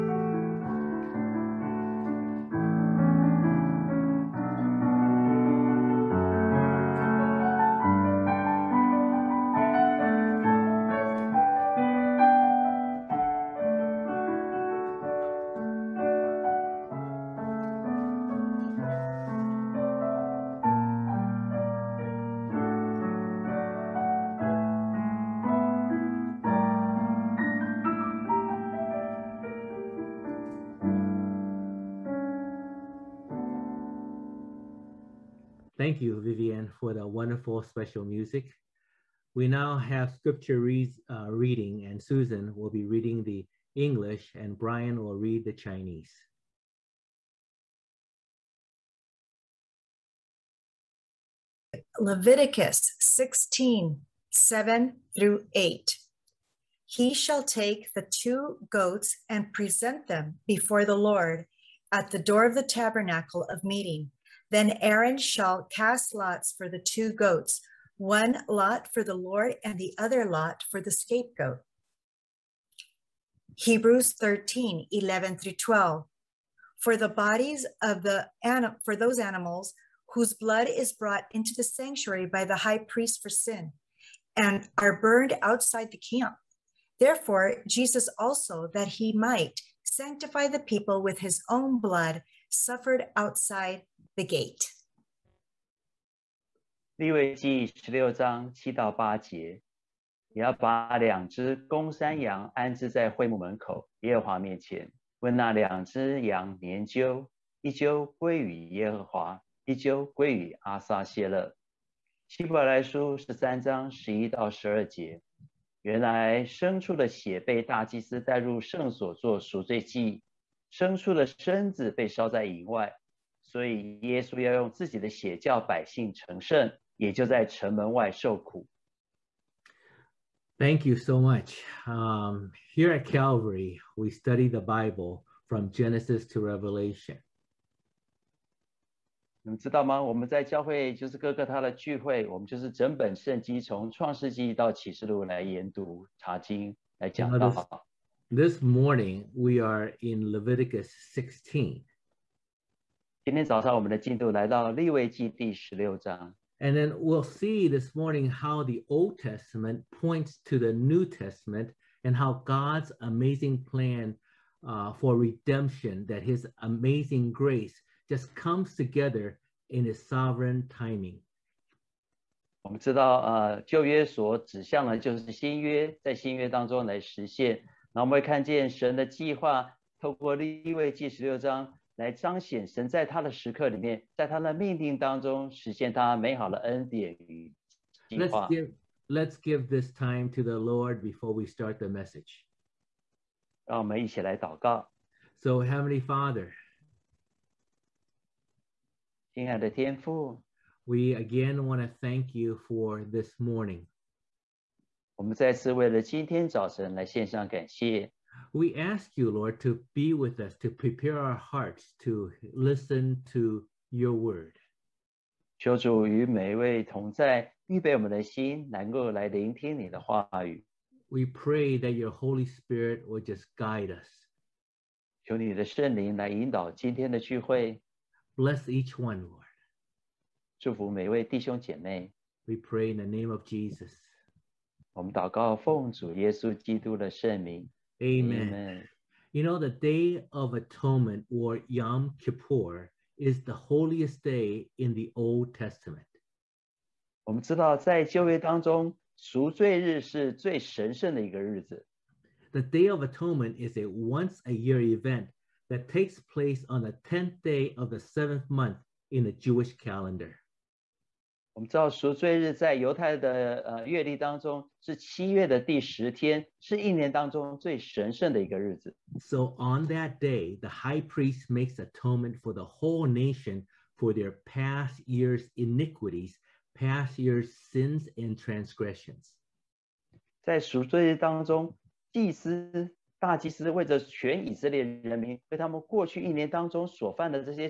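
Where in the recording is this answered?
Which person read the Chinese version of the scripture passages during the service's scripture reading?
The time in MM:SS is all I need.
00:44.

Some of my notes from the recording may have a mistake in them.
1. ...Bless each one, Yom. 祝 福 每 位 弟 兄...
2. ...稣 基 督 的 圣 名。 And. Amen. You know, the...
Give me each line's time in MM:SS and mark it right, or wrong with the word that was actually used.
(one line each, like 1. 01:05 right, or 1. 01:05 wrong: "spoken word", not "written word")
1. 03:48 wrong: "Lord", not "Yom"
2. 03:56 wrong: "Amen", not "And".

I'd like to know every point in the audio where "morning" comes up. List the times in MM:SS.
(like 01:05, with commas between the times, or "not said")
02:28, 02:37, 03:23.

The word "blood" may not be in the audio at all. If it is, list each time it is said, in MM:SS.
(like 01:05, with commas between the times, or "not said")
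01:20, 01:31.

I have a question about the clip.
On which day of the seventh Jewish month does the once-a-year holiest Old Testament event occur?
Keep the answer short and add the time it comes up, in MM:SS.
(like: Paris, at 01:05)
10th day, at 04:17.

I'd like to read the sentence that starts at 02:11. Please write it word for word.
Um, here at Calvary, we study the Bible from Genesis to Revelation.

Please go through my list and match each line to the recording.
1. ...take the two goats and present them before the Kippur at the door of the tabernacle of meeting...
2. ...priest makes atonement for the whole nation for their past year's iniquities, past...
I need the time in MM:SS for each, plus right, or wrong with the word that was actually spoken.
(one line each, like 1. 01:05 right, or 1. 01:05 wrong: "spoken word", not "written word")
1. 00:57 wrong: "Lord", not "Kippur"
2. 04:31 right.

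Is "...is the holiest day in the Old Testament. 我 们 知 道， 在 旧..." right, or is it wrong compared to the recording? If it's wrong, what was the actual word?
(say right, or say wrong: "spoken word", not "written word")
right.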